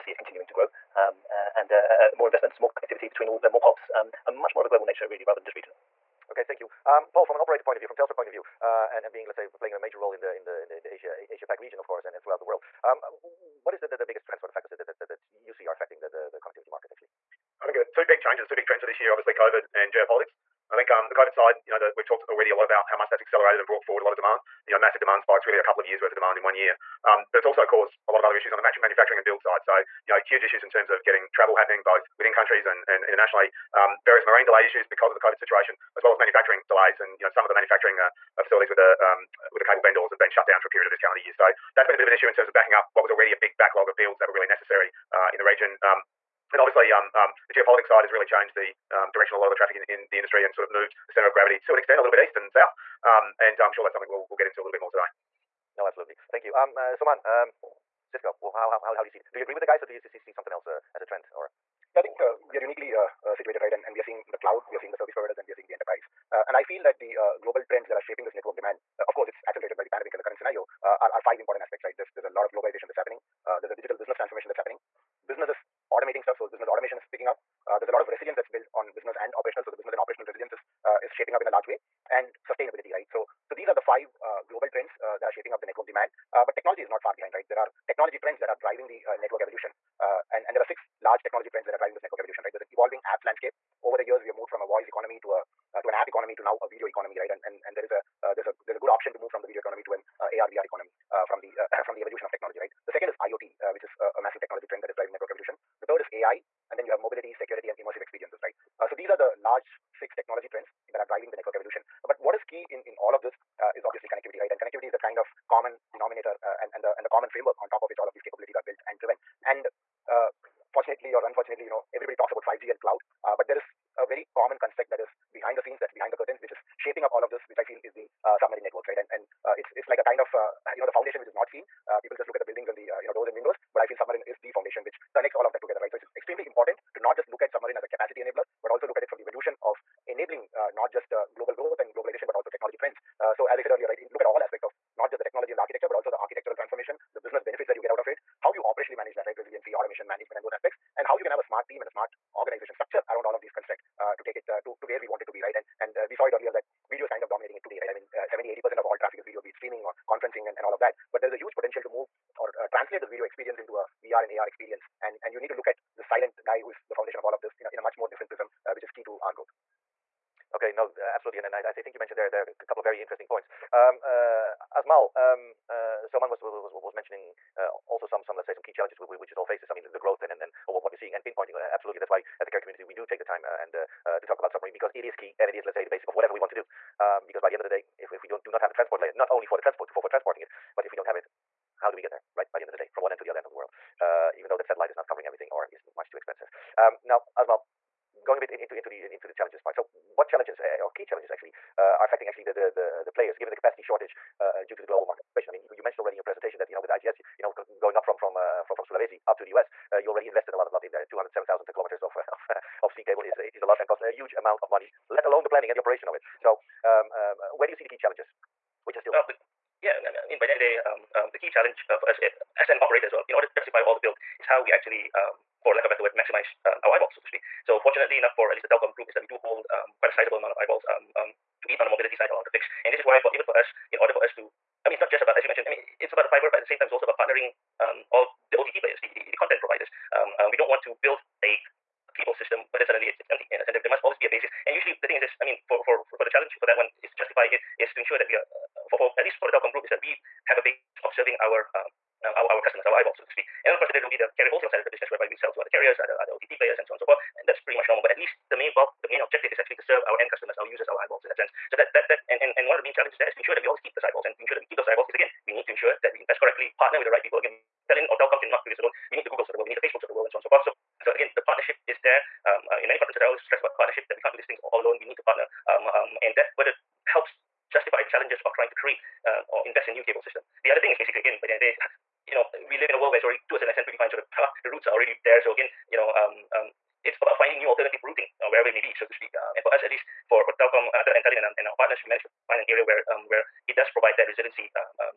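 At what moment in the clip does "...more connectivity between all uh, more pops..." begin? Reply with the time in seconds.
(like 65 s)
2 s.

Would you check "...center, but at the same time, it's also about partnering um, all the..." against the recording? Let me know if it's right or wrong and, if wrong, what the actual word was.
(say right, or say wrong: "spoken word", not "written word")
wrong: "fiber", not "center".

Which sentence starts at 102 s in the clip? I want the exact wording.
The second is IoT, uh, which is a, a massive technology trend that is driving network evolution.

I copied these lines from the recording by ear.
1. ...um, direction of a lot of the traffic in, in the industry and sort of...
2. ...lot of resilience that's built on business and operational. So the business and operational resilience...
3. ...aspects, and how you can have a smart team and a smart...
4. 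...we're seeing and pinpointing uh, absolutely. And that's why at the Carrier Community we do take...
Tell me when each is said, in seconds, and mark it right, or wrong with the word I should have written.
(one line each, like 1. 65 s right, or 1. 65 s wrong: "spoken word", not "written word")
1. 48 s right
2. 77 s right
3. 150 s right
4. 180 s right.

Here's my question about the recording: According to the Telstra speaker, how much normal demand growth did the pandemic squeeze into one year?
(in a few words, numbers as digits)
a couple of years.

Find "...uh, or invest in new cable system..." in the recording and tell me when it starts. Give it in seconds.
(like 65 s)
279 s.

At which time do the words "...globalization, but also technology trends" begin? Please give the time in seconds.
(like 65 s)
141 s.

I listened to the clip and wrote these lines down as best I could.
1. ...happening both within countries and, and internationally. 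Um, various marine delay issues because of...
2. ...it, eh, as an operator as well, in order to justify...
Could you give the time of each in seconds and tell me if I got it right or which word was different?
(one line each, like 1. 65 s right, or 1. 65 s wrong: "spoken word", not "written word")
1. 31 s right
2. 222 s right.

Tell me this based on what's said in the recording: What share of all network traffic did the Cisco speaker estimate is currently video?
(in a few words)
70-80%.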